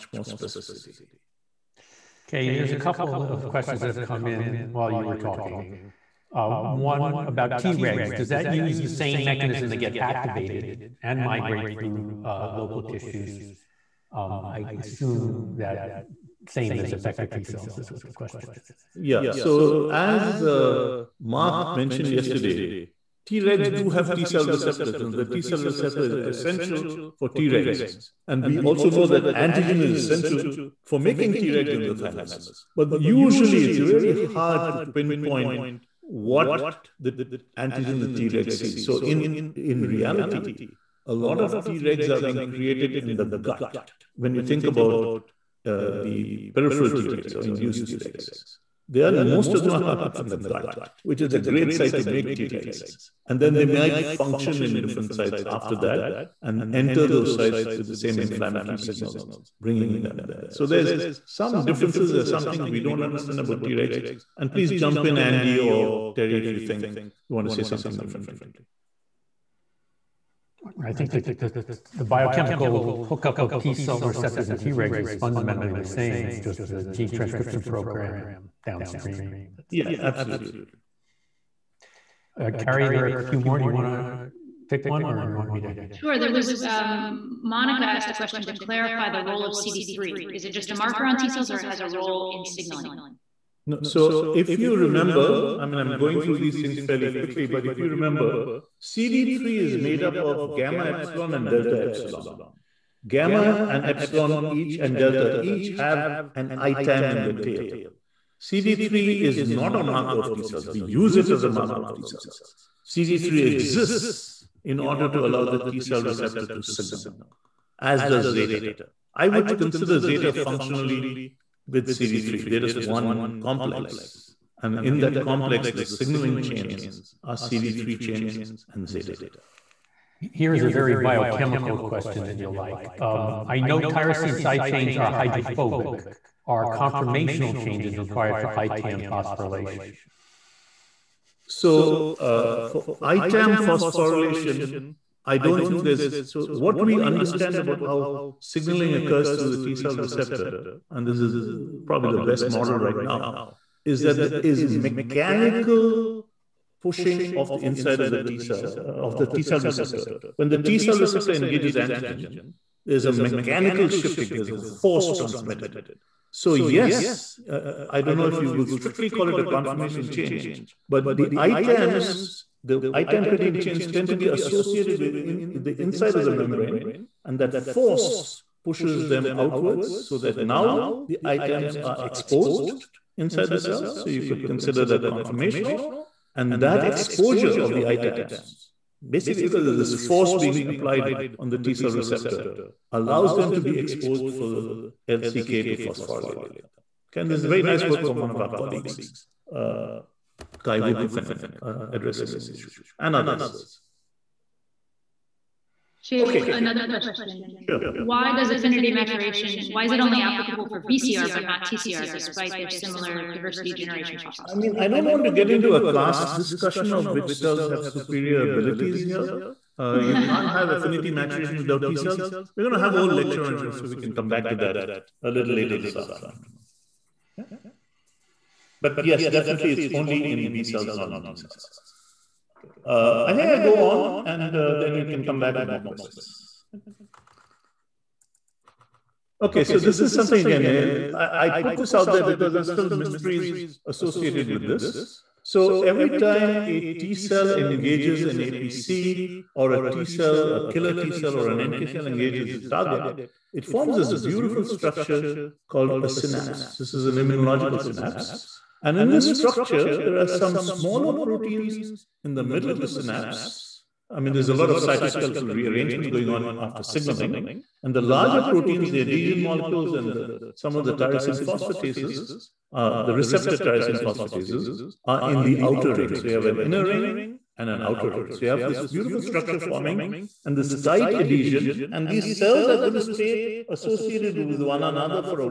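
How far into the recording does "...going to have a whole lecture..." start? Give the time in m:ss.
3:42.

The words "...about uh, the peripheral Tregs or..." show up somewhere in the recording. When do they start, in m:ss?
0:44.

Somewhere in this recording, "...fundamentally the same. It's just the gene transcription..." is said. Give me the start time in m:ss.
1:15.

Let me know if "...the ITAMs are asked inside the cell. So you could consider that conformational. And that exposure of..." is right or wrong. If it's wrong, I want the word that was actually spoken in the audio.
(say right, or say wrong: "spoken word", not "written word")
wrong: "exposed", not "asked".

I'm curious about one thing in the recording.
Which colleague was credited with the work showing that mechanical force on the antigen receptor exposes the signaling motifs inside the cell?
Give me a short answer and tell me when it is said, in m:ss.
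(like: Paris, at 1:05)
Kai Wucherpfennig, at 3:20.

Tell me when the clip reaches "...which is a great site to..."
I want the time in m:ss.
0:51.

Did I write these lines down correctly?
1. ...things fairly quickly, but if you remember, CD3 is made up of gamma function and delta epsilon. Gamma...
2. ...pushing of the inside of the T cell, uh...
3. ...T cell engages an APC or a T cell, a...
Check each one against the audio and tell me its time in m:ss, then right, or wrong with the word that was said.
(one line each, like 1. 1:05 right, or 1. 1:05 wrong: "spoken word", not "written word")
1. 1:36 wrong: "epsilon", not "function"
2. 2:36 right
3. 4:06 right.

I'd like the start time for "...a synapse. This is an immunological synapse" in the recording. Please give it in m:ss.
4:16.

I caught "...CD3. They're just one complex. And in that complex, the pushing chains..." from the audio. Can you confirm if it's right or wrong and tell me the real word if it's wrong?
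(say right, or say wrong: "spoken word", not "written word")
wrong: "signaling", not "pushing".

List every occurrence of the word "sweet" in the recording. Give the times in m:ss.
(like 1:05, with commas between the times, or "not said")
not said.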